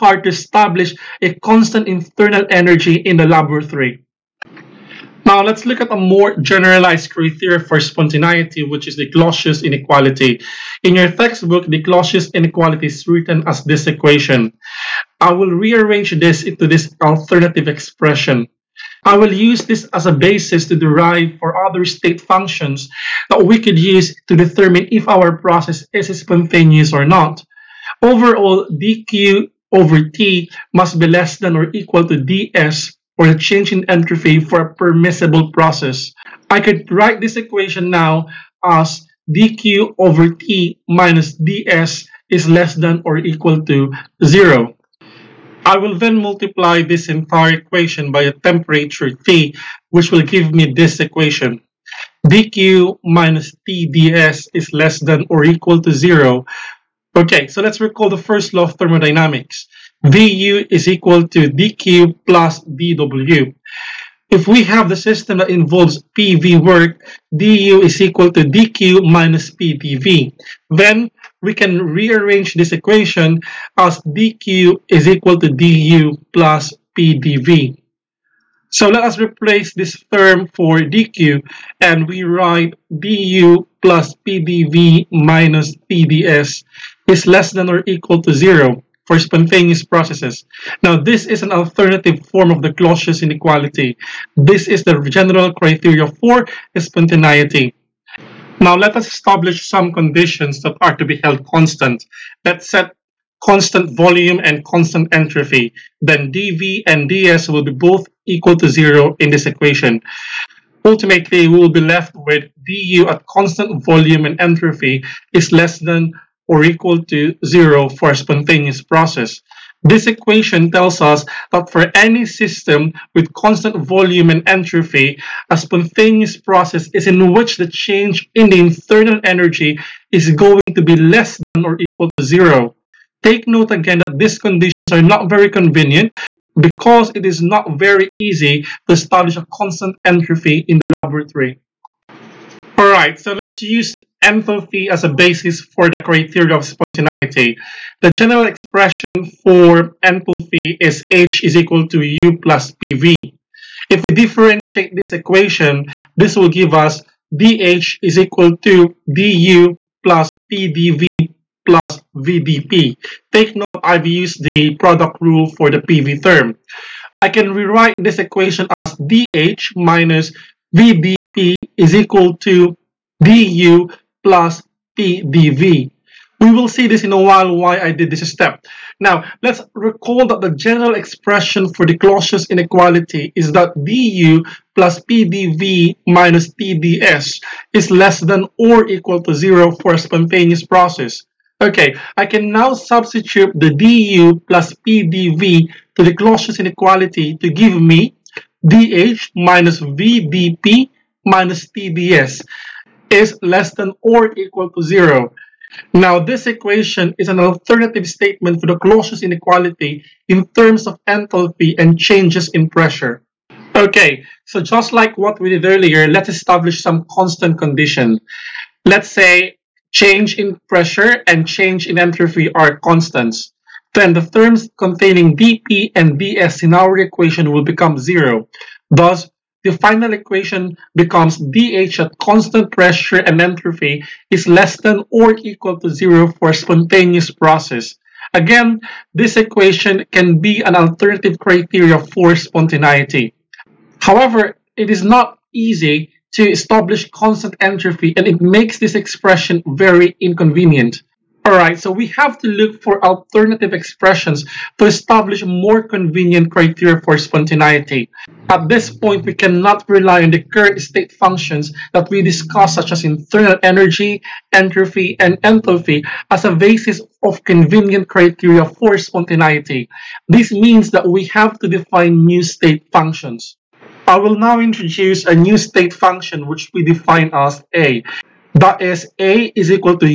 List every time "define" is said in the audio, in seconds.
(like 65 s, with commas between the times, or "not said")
271 s, 276 s.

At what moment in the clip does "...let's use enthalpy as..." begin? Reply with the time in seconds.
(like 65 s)
143 s.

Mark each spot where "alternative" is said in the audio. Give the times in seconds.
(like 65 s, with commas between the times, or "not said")
17 s, 91 s, 207 s, 240 s, 253 s.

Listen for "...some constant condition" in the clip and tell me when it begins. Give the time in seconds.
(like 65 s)
216 s.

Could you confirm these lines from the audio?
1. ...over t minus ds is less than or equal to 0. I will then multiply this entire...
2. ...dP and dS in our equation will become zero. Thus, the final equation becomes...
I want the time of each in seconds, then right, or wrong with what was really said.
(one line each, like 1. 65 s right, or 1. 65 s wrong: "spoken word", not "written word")
1. 39 s right
2. 225 s right.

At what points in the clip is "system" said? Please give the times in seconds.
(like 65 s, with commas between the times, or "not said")
64 s, 122 s.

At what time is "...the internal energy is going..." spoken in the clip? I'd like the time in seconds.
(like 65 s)
128 s.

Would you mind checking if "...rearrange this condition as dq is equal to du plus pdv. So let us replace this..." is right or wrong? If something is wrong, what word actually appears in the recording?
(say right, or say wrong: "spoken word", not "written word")
wrong: "equation", not "condition".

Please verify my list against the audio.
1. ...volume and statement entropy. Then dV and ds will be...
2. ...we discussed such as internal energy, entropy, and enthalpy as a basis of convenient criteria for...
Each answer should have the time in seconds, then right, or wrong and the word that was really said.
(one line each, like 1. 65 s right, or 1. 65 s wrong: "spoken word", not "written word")
1. 103 s wrong: "constant", not "statement"
2. 262 s right.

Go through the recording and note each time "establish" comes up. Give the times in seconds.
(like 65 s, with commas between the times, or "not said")
0 s, 99 s, 138 s, 216 s, 246 s, 254 s.